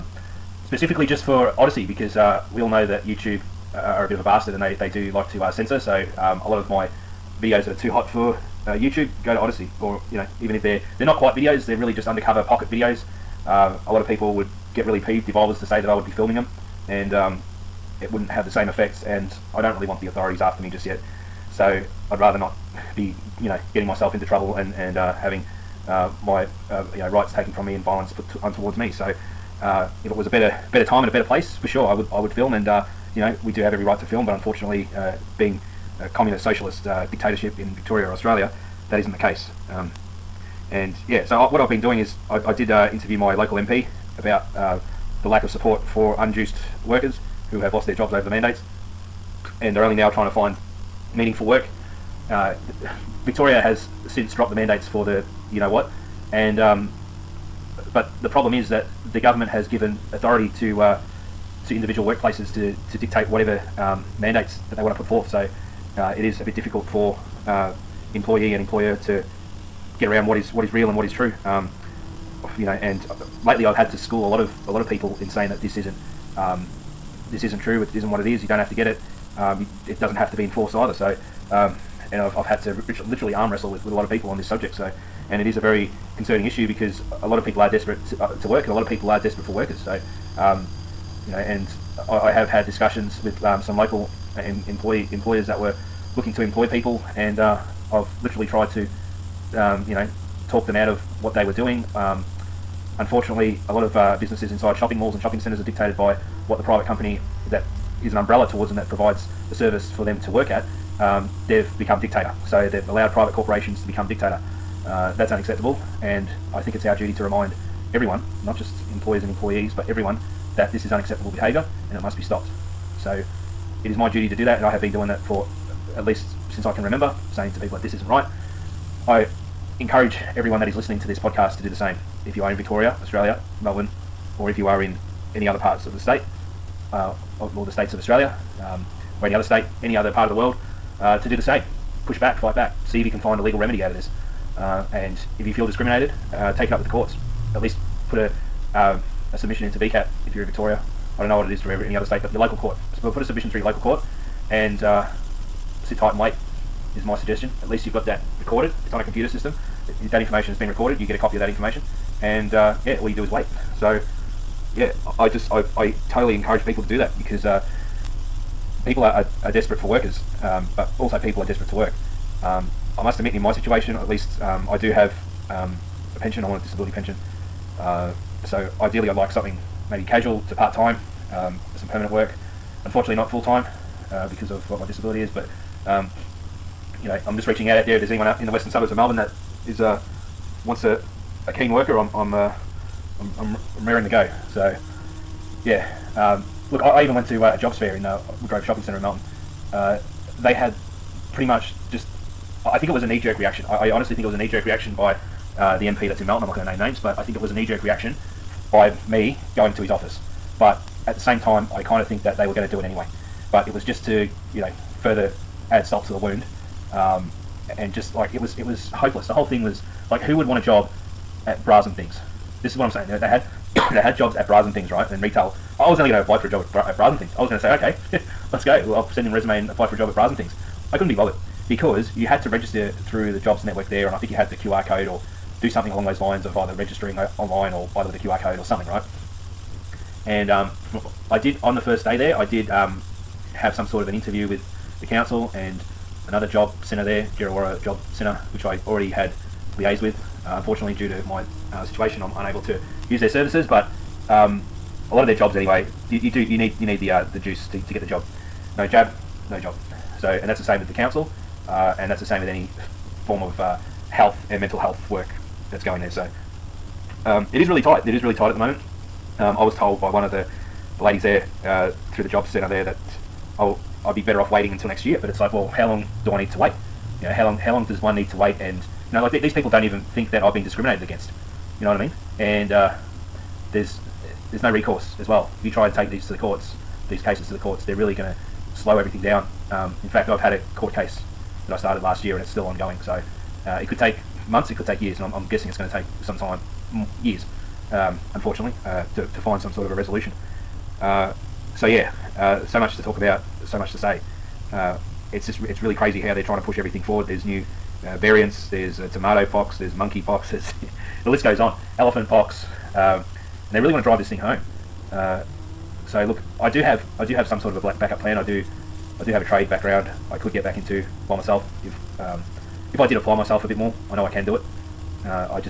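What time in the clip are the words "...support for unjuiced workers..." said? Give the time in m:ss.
0:45.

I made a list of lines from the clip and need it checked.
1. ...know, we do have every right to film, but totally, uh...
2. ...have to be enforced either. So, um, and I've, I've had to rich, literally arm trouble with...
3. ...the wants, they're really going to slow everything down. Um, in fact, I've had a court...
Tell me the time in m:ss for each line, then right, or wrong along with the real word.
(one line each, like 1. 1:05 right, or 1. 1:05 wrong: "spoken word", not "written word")
1. 0:33 wrong: "unfortunately", not "totally"
2. 1:20 wrong: "wrestle", not "trouble"
3. 4:47 wrong: "courts", not "wants".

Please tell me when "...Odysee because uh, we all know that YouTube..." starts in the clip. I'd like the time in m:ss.
0:01.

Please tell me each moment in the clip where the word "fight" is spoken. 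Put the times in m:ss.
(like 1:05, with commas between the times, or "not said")
2:22.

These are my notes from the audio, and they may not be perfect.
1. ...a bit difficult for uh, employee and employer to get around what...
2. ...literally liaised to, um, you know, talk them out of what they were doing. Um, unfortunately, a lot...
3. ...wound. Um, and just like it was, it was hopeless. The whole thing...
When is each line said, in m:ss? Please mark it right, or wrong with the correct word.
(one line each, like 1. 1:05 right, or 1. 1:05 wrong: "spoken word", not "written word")
1. 1:06 right
2. 1:38 wrong: "tried", not "liaised"
3. 3:36 right.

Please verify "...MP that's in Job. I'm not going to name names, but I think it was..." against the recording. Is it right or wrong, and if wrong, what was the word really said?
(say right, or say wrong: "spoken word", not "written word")
wrong: "Melton", not "Job".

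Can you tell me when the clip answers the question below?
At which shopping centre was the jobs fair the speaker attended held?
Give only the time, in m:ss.
3:18.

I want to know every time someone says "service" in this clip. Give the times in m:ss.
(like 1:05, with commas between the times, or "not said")
1:49, 4:13.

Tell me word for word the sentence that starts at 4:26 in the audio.
So um, it is really tight.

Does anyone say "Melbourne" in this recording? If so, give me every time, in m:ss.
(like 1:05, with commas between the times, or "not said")
2:13, 3:08.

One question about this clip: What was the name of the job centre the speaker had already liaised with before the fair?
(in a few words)
Djerriwarrh Job Centre.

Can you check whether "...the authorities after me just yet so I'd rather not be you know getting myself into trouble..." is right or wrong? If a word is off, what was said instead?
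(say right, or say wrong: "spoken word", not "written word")
right.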